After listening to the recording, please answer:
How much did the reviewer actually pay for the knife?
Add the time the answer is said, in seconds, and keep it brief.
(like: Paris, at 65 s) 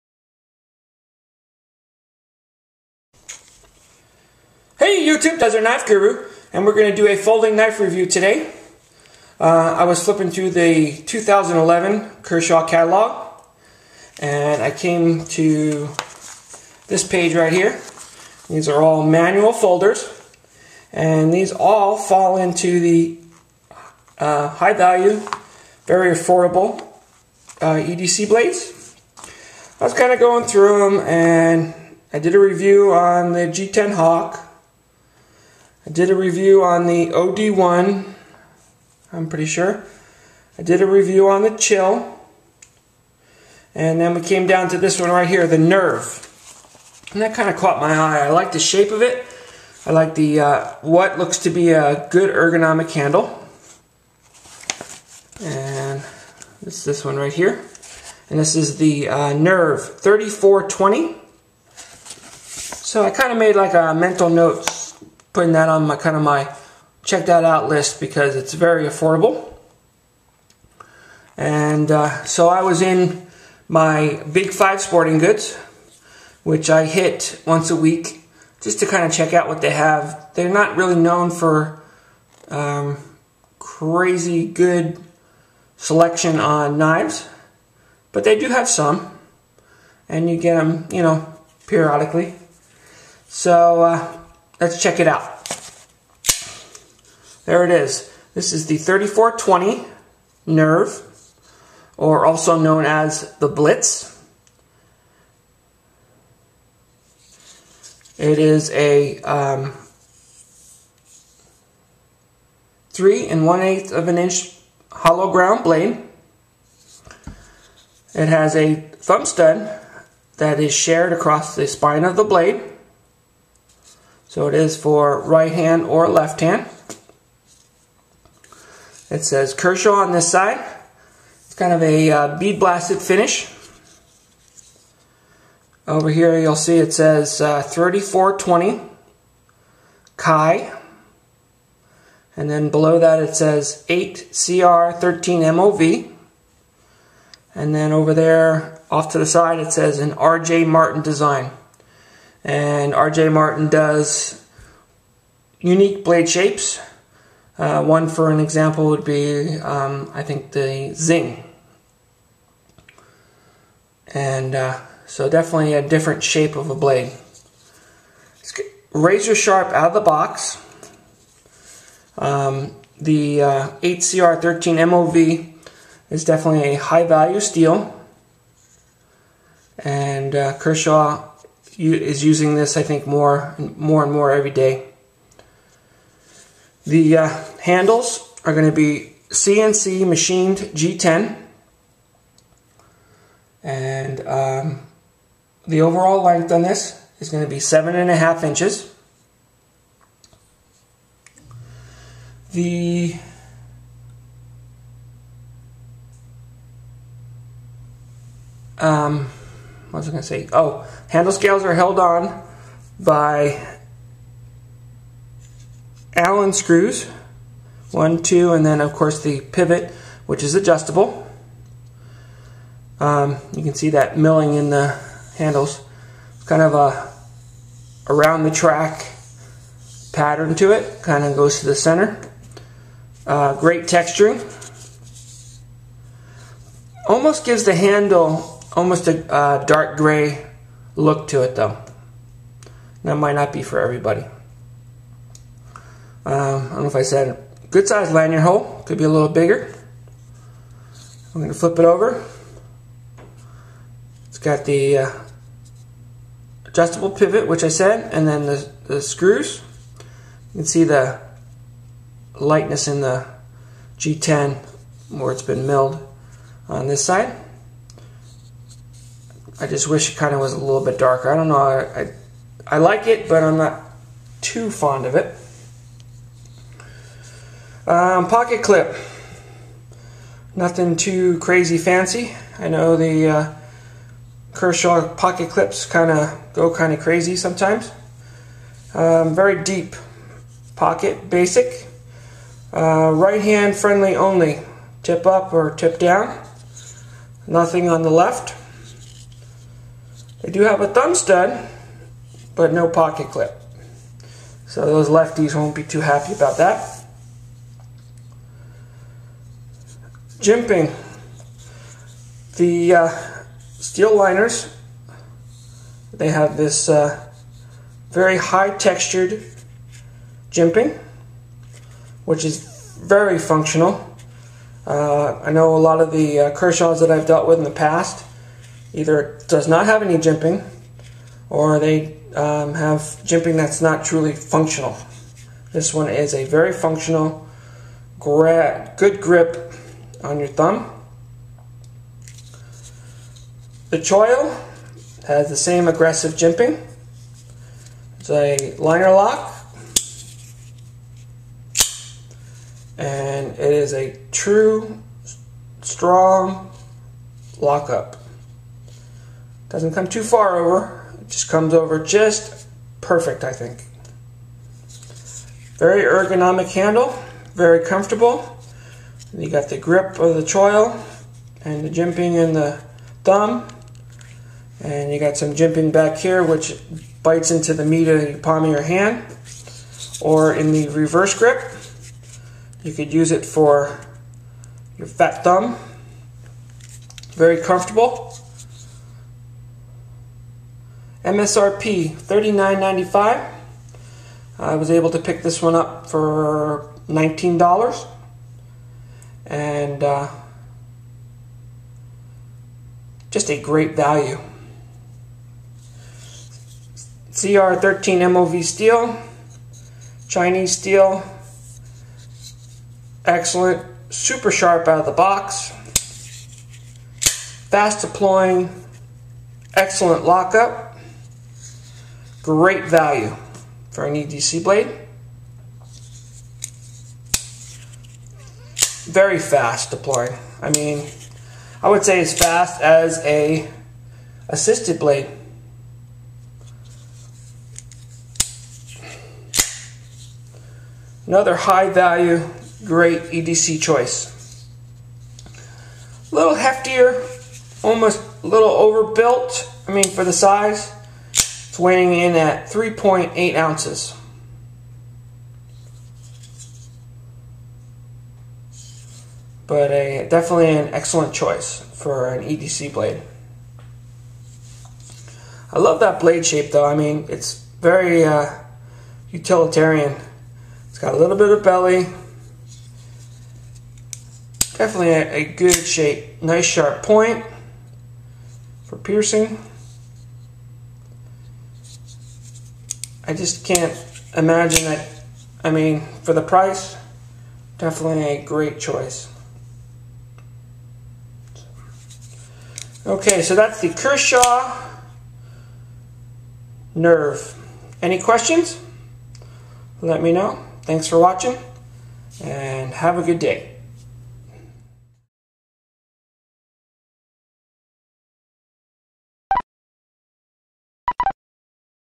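$19, at 397 s.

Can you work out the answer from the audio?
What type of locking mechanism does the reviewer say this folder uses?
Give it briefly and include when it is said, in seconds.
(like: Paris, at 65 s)
Liner lock, at 348 s.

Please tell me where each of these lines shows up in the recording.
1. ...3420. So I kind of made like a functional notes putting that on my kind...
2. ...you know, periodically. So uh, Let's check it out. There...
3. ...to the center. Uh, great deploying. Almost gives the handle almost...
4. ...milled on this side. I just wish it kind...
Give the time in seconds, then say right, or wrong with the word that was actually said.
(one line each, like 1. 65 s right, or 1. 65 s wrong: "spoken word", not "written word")
1. 59 s wrong: "mental", not "functional"
2. 90 s right
3. 231 s wrong: "texturing", not "deploying"
4. 265 s right.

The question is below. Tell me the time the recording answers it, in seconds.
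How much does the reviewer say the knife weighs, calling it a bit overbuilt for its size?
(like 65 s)
452 s.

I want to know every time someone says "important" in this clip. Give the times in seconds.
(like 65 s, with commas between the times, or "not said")
not said.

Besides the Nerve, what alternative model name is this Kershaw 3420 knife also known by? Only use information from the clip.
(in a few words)
Blitz.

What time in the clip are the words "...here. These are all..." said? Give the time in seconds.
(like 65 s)
17 s.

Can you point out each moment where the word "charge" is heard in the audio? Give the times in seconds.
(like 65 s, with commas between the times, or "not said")
not said.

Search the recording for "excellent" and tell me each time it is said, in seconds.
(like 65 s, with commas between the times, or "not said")
413 s, 419 s, 460 s.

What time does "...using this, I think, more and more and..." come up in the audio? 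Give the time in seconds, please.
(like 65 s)
182 s.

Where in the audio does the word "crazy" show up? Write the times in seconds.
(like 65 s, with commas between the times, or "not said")
83 s, 281 s, 286 s.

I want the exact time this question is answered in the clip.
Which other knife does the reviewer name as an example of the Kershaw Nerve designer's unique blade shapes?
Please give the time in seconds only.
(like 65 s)
160 s.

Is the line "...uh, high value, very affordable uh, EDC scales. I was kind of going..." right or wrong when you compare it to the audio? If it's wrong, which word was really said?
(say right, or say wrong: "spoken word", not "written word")
wrong: "blades", not "scales".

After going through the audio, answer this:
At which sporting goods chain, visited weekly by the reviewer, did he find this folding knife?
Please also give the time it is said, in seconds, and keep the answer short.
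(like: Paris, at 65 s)
Big Five Sporting Goods, at 74 s.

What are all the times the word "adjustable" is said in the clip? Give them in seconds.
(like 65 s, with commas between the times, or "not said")
220 s, 256 s.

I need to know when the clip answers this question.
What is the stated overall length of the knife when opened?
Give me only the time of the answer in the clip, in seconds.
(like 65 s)
197 s.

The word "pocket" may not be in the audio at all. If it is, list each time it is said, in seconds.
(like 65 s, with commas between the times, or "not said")
278 s, 285 s, 290 s, 302 s.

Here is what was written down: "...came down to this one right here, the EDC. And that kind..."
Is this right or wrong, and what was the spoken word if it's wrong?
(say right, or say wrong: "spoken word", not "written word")
wrong: "Nerve", not "EDC".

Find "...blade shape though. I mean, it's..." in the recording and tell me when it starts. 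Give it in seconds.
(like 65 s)
466 s.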